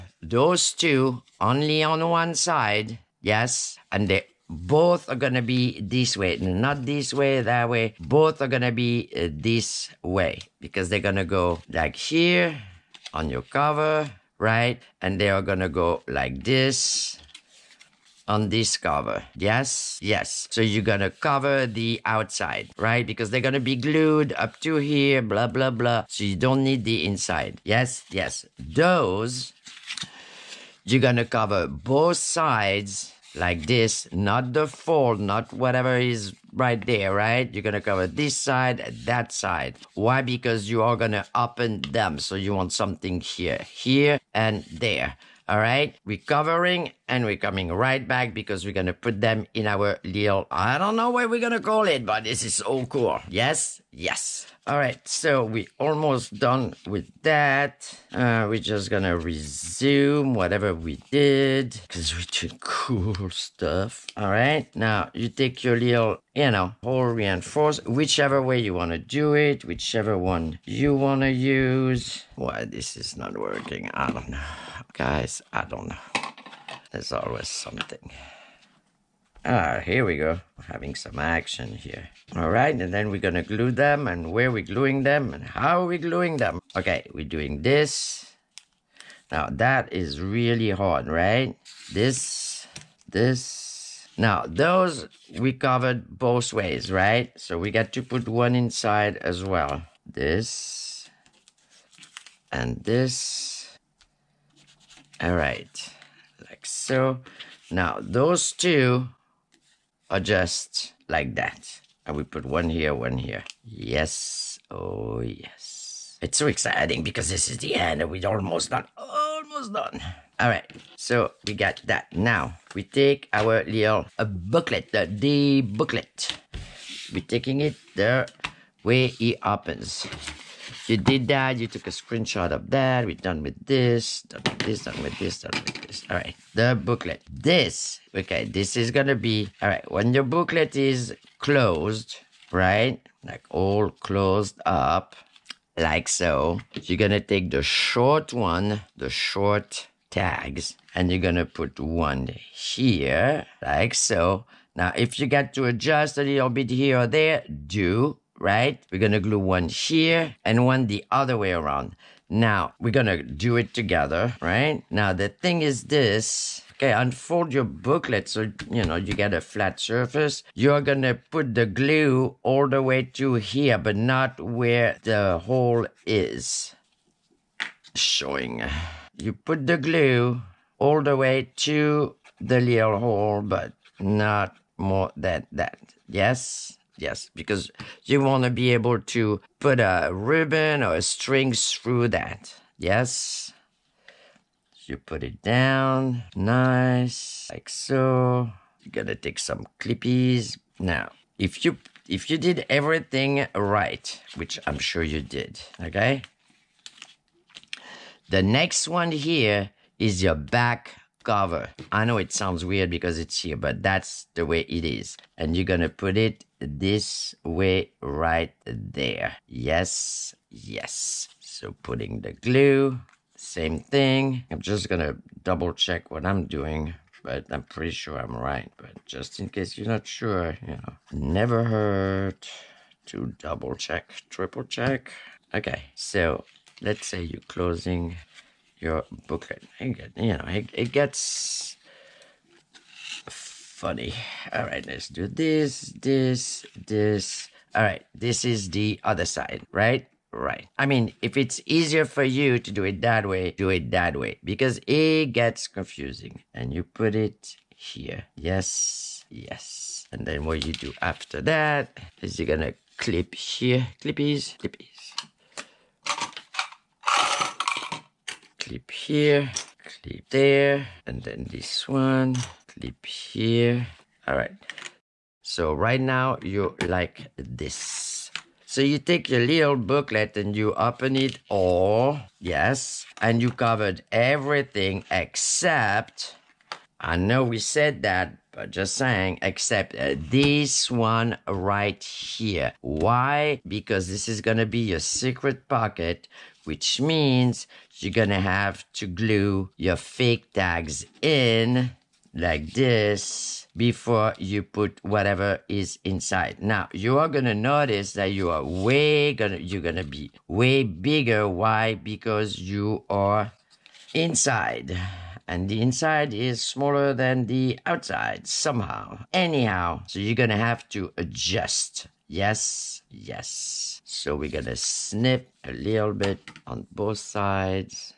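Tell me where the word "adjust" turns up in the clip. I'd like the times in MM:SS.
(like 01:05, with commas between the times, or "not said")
02:35, 05:21.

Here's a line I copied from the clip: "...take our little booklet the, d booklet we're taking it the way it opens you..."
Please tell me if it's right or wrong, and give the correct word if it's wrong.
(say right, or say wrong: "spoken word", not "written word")
right.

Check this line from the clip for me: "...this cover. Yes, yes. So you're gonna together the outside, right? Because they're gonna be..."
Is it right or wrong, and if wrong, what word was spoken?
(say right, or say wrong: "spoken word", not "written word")
wrong: "cover", not "together".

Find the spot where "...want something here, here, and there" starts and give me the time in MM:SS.
00:42.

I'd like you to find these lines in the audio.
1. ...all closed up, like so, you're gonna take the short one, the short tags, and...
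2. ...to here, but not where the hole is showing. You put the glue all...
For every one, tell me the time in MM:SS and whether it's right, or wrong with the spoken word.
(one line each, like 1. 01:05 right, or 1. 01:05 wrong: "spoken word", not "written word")
1. 02:23 right
2. 02:53 right.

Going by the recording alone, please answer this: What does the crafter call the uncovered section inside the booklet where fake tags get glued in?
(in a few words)
secret pocket.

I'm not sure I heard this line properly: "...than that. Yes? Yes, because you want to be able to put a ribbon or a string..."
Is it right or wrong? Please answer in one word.
right.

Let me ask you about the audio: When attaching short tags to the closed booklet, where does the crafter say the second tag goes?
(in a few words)
back cover.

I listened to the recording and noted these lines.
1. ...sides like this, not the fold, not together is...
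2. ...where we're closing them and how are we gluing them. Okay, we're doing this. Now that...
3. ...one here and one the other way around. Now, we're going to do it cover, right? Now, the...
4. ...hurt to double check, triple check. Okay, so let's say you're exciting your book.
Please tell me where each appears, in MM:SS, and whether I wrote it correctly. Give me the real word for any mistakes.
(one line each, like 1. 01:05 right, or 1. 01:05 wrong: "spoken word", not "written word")
1. 00:32 wrong: "whatever", not "together"
2. 01:24 wrong: "gluing", not "closing"
3. 02:39 wrong: "together", not "cover"
4. 03:51 wrong: "closing", not "exciting".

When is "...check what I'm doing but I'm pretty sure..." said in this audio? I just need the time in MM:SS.
03:45.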